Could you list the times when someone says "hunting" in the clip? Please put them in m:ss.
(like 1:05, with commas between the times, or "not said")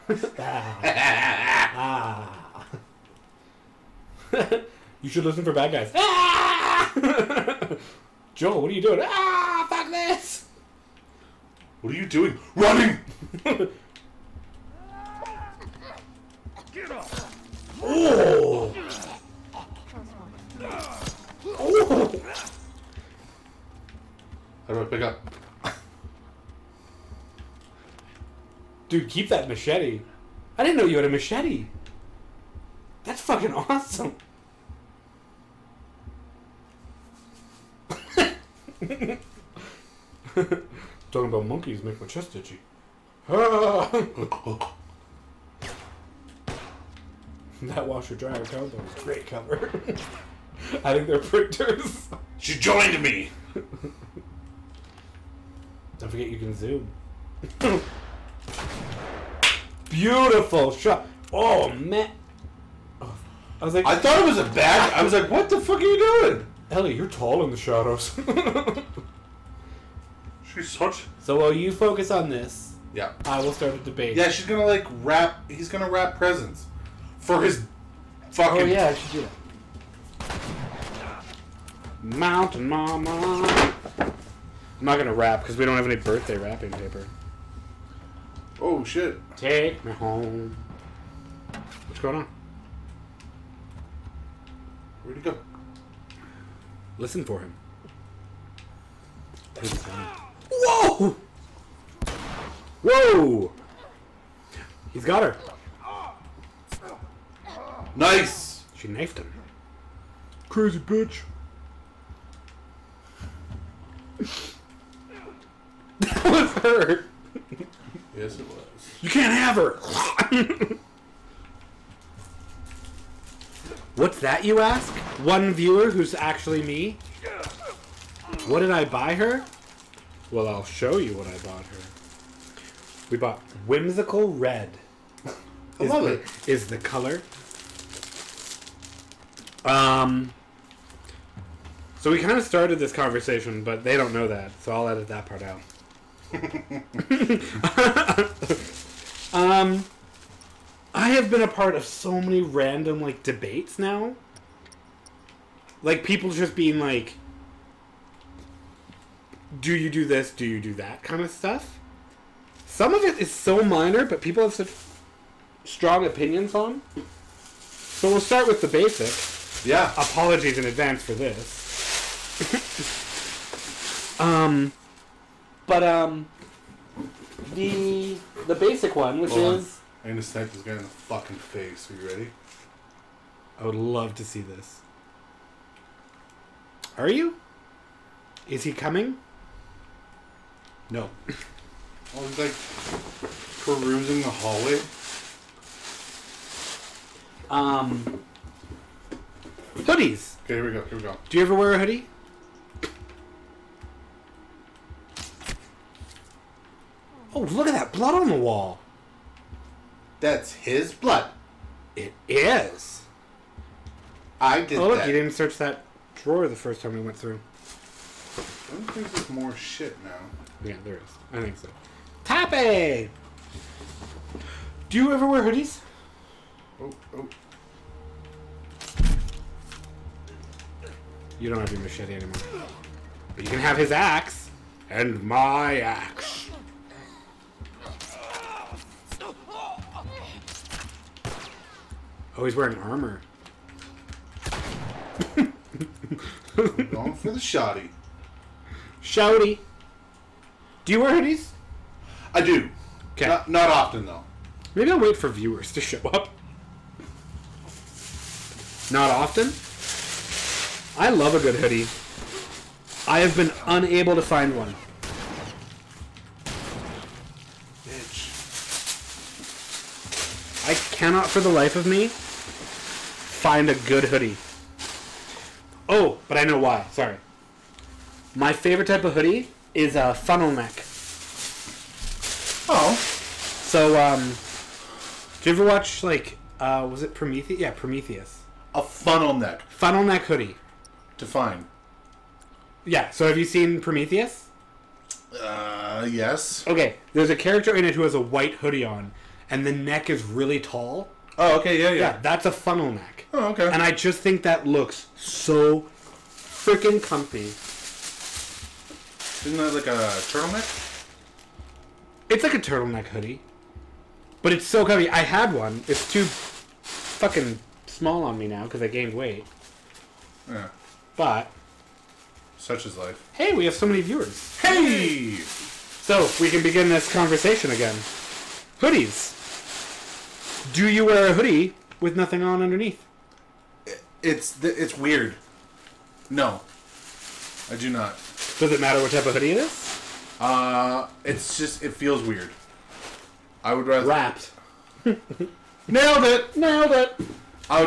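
not said.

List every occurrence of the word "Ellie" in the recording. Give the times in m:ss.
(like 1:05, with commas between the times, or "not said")
1:06.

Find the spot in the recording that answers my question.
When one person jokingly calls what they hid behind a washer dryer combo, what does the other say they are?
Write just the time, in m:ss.
0:51.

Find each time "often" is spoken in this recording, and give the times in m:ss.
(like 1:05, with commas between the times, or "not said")
4:13, 4:19.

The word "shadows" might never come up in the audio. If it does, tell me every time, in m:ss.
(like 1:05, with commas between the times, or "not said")
1:07.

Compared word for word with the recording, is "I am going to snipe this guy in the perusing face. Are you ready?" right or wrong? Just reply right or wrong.
wrong.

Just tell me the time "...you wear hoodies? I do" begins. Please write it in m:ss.
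4:10.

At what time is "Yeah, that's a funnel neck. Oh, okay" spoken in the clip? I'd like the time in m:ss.
5:02.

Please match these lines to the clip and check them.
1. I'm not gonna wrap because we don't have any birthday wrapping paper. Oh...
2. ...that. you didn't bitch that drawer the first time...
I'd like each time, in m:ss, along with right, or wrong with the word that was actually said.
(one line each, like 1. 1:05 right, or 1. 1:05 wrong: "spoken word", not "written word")
1. 1:23 right
2. 3:34 wrong: "search", not "bitch".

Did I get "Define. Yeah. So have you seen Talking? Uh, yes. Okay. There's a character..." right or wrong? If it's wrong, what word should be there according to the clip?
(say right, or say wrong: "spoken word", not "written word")
wrong: "Prometheus", not "Talking".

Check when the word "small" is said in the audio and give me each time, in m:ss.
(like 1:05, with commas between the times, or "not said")
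5:17.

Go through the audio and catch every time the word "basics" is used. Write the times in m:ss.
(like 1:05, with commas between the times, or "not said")
2:48, 2:58.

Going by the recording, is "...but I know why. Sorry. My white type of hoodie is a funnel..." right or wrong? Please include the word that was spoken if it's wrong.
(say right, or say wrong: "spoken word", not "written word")
wrong: "favorite", not "white".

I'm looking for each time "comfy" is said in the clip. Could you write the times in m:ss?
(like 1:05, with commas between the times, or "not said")
5:07, 5:14.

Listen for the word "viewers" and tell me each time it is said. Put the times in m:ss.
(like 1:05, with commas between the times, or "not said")
2:05, 4:15, 5:24.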